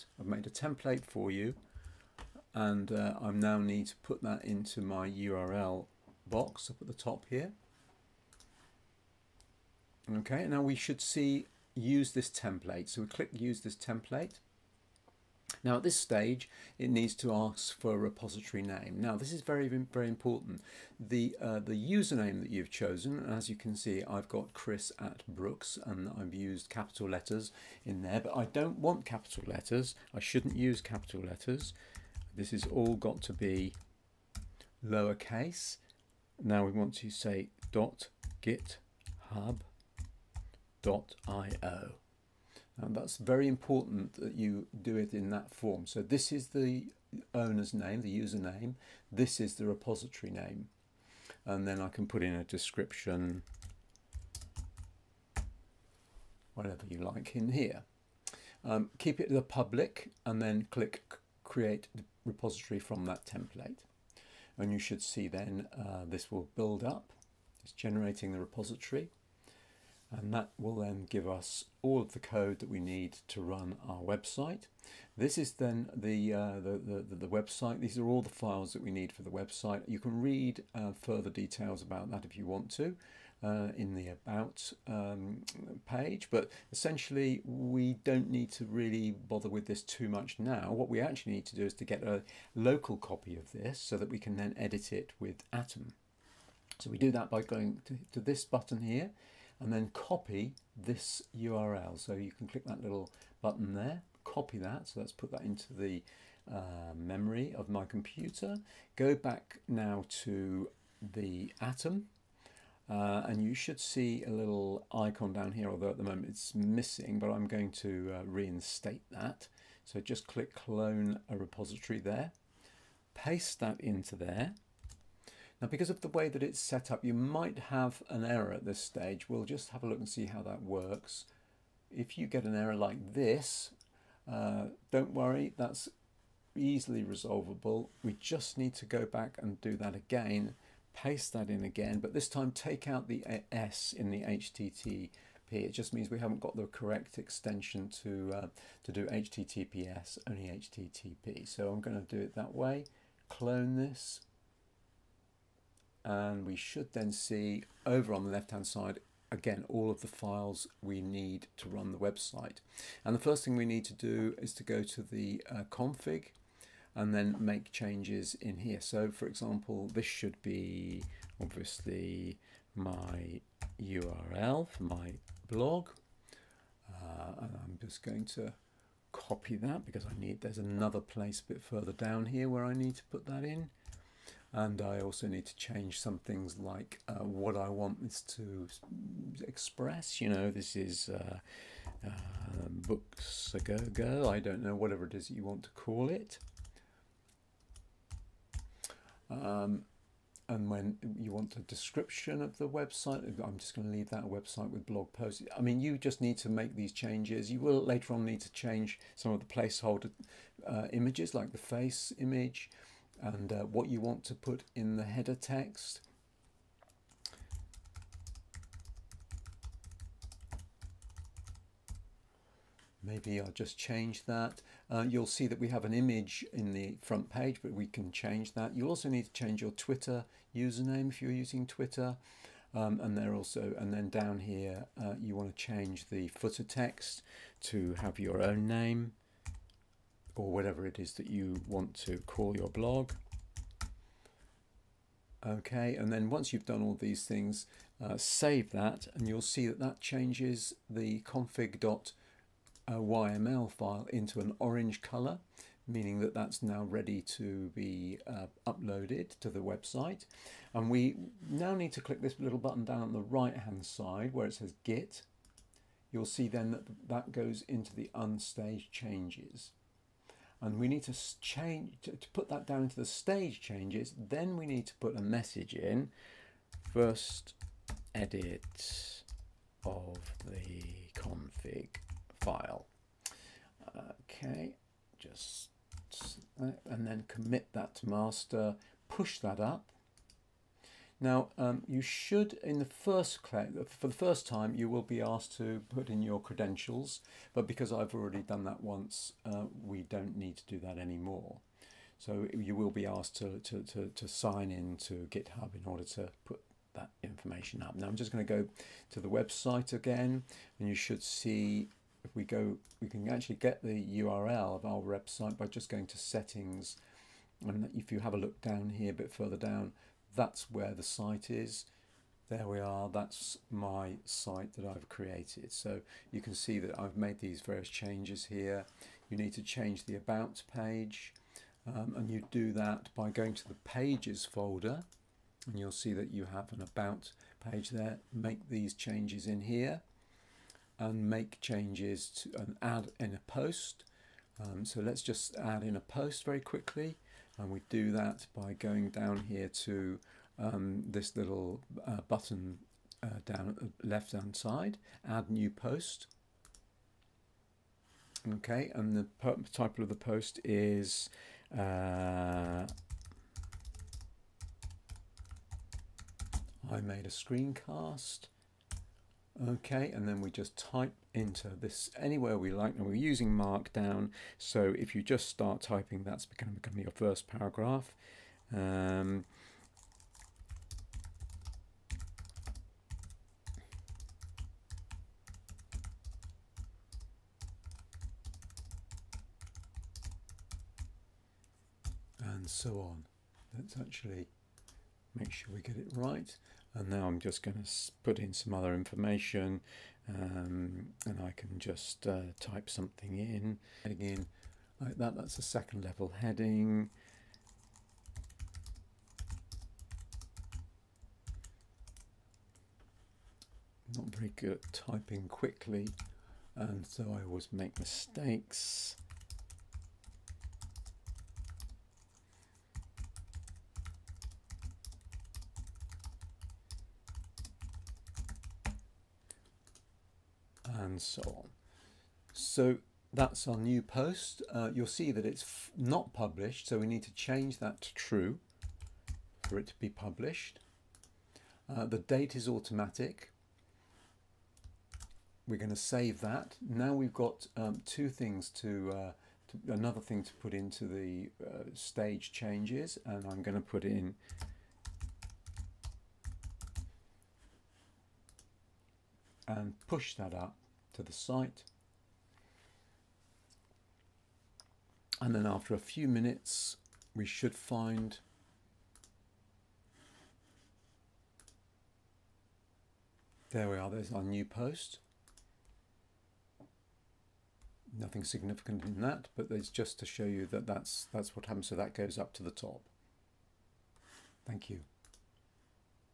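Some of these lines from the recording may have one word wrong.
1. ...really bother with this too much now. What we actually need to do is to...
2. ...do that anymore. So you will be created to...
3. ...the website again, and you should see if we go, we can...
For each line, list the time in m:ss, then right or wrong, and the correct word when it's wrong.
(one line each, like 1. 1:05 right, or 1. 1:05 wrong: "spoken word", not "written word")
1. 1:28 right
2. 5:00 wrong: "asked", not "created"
3. 5:09 right.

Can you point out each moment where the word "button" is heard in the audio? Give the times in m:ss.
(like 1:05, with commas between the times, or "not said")
1:38, 1:43, 4:22, 5:52.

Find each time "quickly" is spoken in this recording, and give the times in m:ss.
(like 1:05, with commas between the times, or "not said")
5:46, 6:55.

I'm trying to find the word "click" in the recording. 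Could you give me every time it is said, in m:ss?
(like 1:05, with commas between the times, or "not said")
0:13, 1:00, 1:42, 2:00, 4:21.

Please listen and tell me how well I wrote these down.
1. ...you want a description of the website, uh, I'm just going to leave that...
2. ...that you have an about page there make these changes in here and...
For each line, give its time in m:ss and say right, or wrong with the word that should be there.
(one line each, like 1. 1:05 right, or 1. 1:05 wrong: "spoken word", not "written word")
1. 3:21 right
2. 5:36 right.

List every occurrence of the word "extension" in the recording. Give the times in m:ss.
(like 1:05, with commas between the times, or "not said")
2:27.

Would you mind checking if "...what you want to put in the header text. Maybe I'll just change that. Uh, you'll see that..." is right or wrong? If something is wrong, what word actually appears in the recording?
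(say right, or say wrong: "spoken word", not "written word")
right.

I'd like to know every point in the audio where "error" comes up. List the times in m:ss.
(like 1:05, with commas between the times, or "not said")
2:08, 2:12.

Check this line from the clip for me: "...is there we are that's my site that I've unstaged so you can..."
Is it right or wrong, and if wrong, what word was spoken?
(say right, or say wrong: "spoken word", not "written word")
wrong: "created", not "unstaged".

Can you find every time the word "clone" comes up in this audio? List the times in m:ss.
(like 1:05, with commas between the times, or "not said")
2:00, 2:33.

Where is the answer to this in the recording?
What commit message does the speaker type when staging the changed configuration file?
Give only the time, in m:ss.
4:36.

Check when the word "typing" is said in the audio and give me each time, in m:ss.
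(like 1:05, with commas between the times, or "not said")
6:15, 6:54.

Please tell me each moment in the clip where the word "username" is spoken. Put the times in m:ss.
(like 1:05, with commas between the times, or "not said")
0:21, 0:48, 3:50.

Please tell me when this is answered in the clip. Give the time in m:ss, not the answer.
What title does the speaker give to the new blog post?
6:06.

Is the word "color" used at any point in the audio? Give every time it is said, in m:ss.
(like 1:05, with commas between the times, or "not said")
4:15.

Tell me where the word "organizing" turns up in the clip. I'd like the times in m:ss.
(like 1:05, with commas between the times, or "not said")
not said.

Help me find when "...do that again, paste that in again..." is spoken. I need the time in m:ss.
2:19.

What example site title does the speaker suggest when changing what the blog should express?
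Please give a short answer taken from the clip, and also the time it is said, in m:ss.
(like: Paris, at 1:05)
Books a go go, at 3:12.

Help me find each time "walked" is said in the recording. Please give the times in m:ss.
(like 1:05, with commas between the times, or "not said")
not said.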